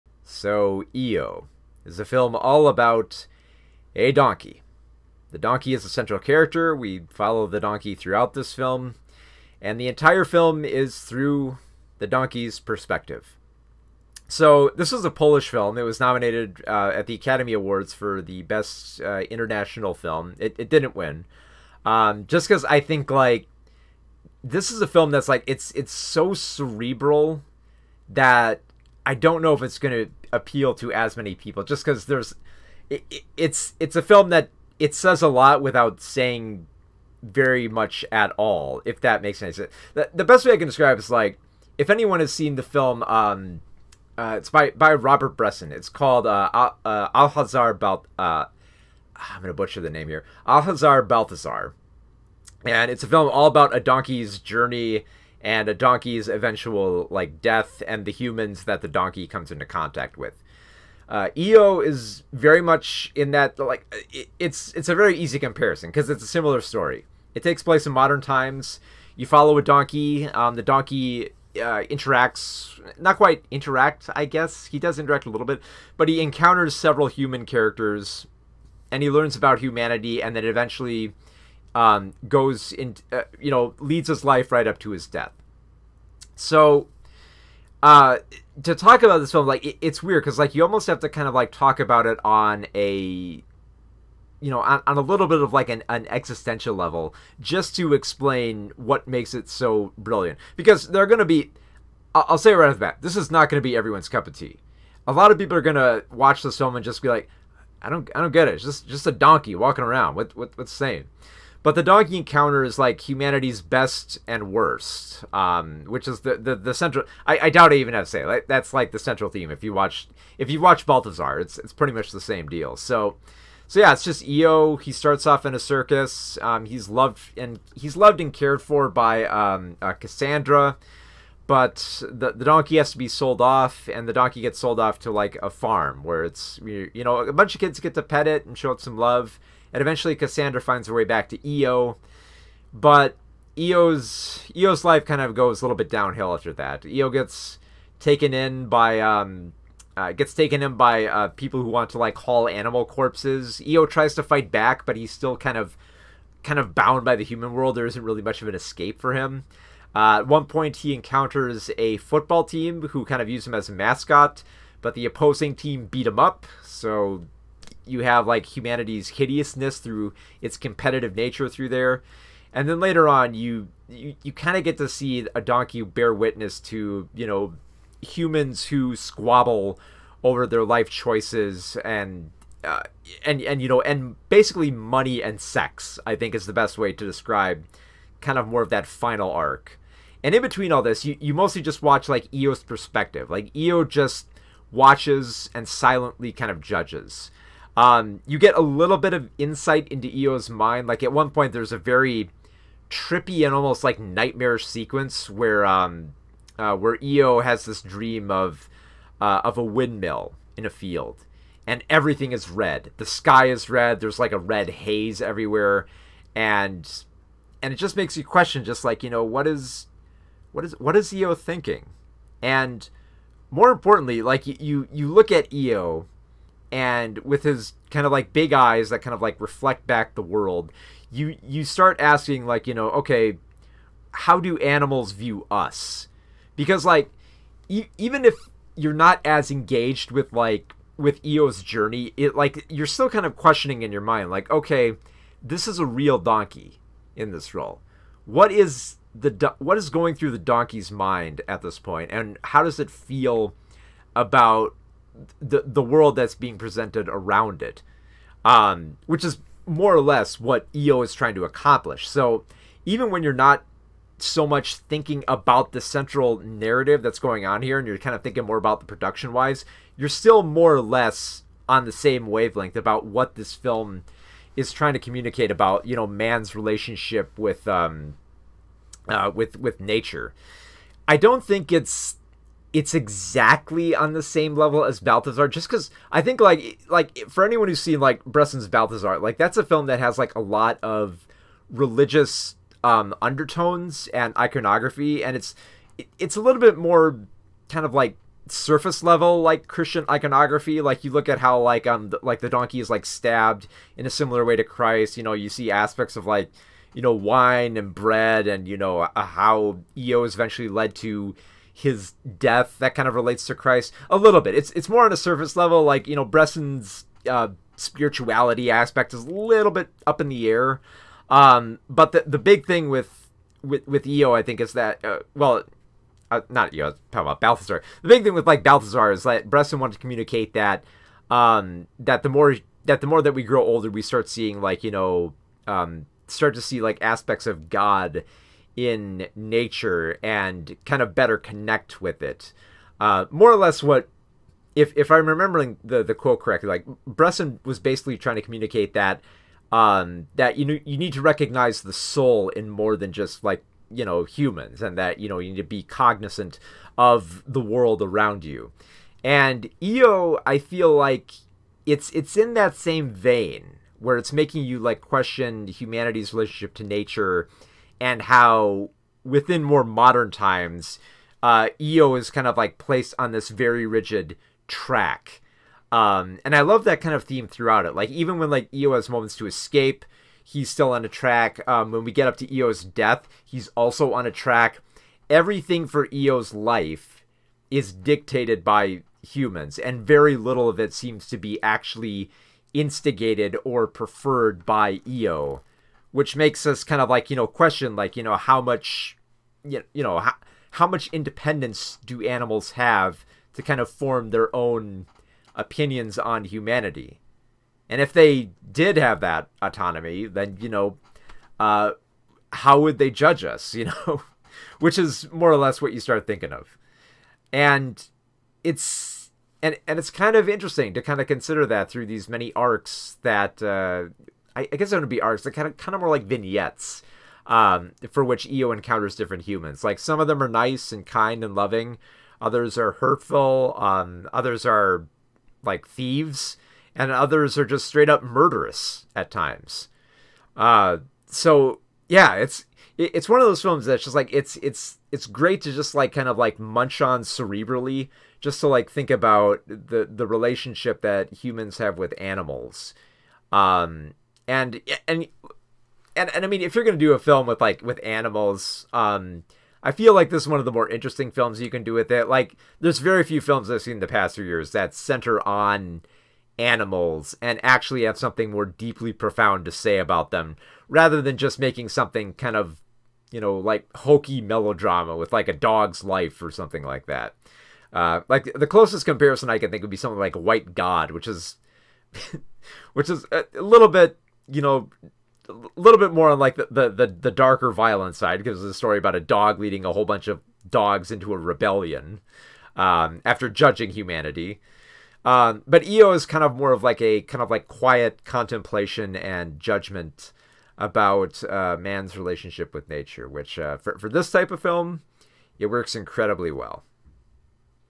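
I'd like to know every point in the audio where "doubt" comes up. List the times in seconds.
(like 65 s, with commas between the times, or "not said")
117 s.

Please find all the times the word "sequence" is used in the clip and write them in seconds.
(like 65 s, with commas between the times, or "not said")
204 s.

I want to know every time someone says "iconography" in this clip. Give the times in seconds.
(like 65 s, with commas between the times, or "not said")
294 s, 300 s.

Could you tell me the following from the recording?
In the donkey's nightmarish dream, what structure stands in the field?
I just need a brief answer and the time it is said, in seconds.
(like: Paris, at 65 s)
windmill, at 209 s.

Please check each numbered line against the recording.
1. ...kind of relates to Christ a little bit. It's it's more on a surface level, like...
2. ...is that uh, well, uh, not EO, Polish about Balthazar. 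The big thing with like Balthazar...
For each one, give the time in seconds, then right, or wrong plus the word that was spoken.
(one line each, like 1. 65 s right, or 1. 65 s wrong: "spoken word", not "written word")
1. 312 s right
2. 324 s wrong: "Talk", not "Polish".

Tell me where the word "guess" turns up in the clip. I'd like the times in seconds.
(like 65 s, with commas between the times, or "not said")
74 s, 424 s.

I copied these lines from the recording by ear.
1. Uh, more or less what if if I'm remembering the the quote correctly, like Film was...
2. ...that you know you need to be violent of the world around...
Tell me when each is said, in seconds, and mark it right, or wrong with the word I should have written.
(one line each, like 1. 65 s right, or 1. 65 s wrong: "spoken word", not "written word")
1. 342 s wrong: "Bresson", not "Film"
2. 354 s wrong: "cognizant", not "violent".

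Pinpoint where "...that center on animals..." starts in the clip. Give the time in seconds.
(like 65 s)
464 s.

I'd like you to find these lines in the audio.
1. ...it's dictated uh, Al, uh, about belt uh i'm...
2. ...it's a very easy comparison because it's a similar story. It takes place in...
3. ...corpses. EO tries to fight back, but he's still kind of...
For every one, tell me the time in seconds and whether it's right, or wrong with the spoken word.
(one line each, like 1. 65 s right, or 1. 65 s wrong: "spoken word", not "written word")
1. 45 s wrong: "called", not "dictated"
2. 64 s right
3. 152 s right.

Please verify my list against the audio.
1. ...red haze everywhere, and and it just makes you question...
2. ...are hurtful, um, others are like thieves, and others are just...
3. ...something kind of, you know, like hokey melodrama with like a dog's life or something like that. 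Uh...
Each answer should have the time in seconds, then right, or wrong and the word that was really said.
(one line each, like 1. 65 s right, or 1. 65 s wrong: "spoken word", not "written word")
1. 214 s right
2. 432 s right
3. 471 s right.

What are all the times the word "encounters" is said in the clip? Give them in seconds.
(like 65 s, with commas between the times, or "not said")
76 s, 112 s, 160 s, 428 s.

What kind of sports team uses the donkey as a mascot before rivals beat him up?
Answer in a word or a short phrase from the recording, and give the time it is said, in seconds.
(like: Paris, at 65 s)
football team, at 161 s.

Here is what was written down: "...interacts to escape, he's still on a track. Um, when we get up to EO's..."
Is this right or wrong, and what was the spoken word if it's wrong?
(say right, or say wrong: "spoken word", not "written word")
wrong: "moments", not "interacts".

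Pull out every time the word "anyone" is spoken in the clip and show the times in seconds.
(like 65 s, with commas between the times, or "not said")
41 s, 287 s.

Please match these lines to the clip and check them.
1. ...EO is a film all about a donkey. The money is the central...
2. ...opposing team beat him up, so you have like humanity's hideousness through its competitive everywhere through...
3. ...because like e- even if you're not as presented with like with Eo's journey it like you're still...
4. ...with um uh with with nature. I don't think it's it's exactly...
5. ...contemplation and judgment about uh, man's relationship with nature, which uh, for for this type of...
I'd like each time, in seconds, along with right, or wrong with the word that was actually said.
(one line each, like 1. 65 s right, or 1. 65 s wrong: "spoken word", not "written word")
1. 0 s wrong: "donkey", not "money"
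2. 165 s wrong: "nature", not "everywhere"
3. 236 s wrong: "engaged", not "presented"
4. 277 s right
5. 498 s right.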